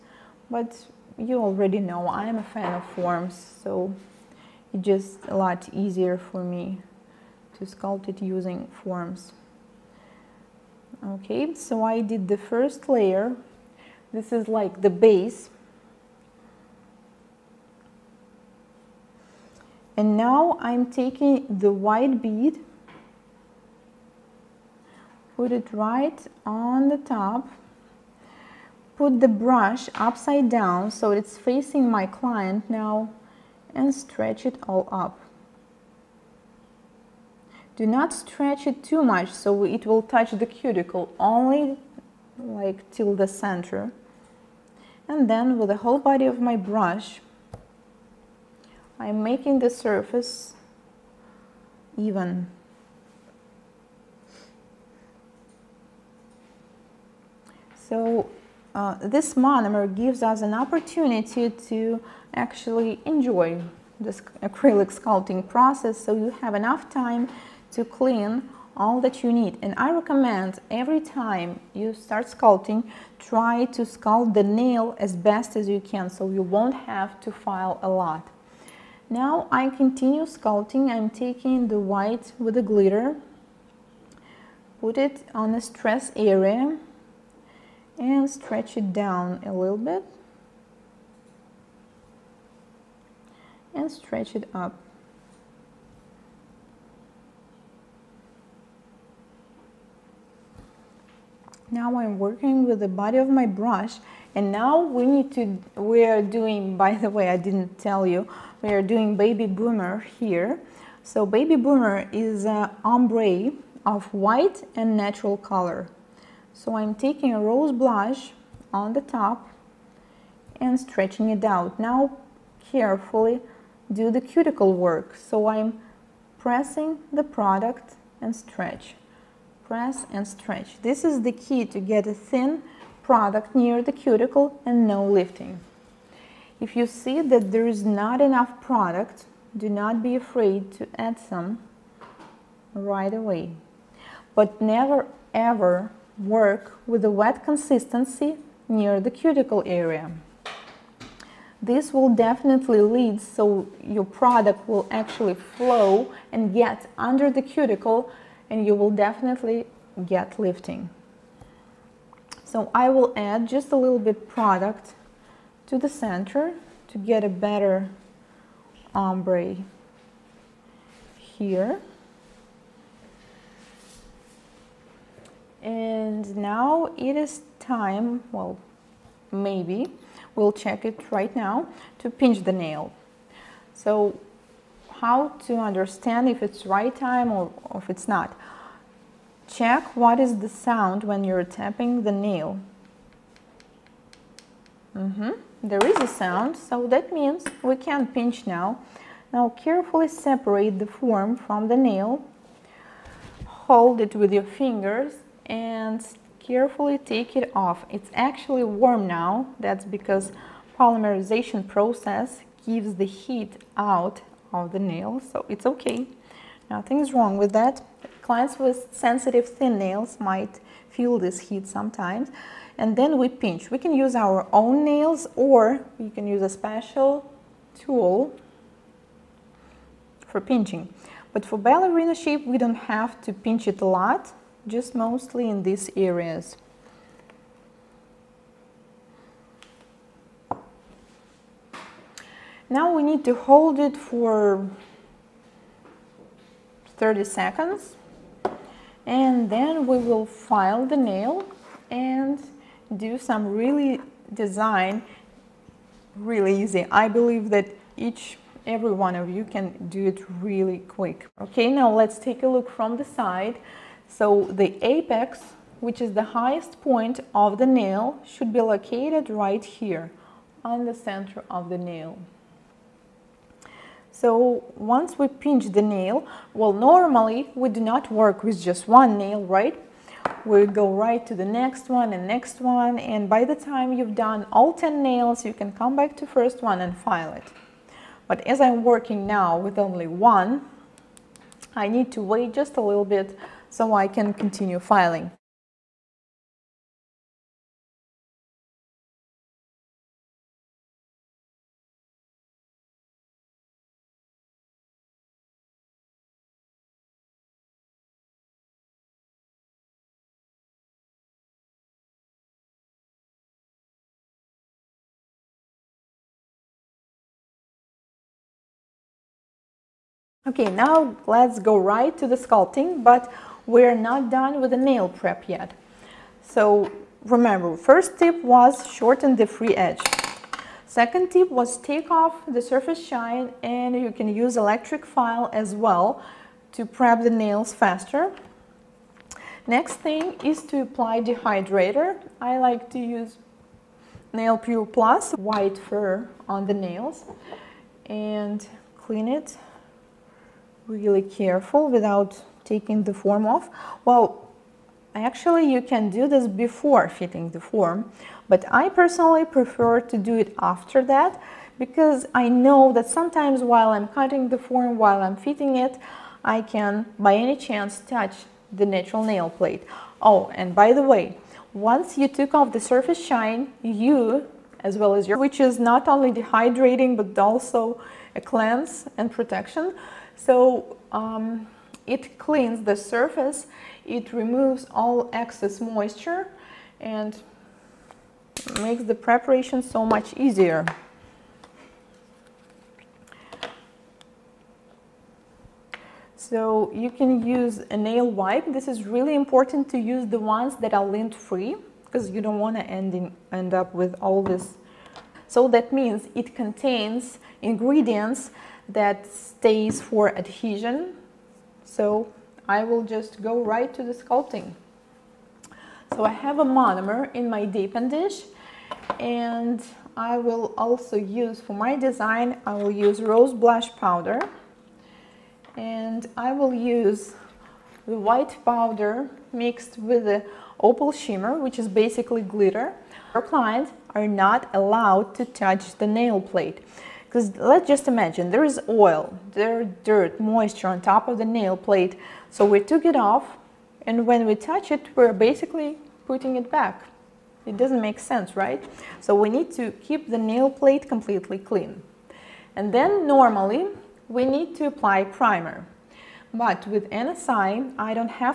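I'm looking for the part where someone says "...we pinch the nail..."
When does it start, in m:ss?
4:35.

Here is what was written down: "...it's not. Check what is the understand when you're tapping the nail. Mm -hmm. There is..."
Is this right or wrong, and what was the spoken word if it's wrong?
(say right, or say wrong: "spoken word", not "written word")
wrong: "sound", not "understand".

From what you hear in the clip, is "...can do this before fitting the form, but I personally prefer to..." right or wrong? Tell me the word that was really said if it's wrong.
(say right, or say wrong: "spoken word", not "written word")
right.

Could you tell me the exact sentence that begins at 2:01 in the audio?
Now carefully do the cuticle work.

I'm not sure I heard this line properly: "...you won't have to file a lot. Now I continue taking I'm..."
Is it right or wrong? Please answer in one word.
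wrong.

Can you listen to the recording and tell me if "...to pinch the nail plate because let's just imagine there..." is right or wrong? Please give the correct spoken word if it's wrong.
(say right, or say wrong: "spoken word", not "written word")
wrong: "touch", not "pinch".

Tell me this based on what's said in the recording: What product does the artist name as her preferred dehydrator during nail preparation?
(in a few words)
Nail Pure Plus.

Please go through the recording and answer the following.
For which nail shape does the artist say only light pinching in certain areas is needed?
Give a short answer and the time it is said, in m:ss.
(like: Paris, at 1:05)
Ballerina, at 3:51.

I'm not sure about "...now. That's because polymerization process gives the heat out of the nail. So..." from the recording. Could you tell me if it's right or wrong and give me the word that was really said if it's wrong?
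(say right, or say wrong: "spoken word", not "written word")
right.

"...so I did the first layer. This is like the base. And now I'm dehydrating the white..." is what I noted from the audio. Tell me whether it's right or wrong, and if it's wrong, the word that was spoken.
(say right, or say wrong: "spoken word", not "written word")
wrong: "taking", not "dehydrating".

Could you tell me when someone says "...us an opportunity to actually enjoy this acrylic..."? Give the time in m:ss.
1:00.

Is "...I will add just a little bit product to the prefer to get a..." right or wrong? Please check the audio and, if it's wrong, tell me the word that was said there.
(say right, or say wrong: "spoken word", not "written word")
wrong: "center", not "prefer".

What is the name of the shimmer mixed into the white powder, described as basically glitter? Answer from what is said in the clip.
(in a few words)
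Opal shimmer.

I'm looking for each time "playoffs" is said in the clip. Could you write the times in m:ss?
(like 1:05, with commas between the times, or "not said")
not said.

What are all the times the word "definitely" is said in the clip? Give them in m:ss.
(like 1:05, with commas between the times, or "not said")
2:32, 2:38.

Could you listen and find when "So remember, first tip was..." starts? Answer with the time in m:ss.
5:26.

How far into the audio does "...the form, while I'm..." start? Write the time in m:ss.
6:04.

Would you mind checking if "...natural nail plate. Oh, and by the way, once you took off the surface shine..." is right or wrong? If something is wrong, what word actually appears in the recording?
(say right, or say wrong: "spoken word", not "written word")
right.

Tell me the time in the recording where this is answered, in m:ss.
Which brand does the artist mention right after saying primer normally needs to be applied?
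7:37.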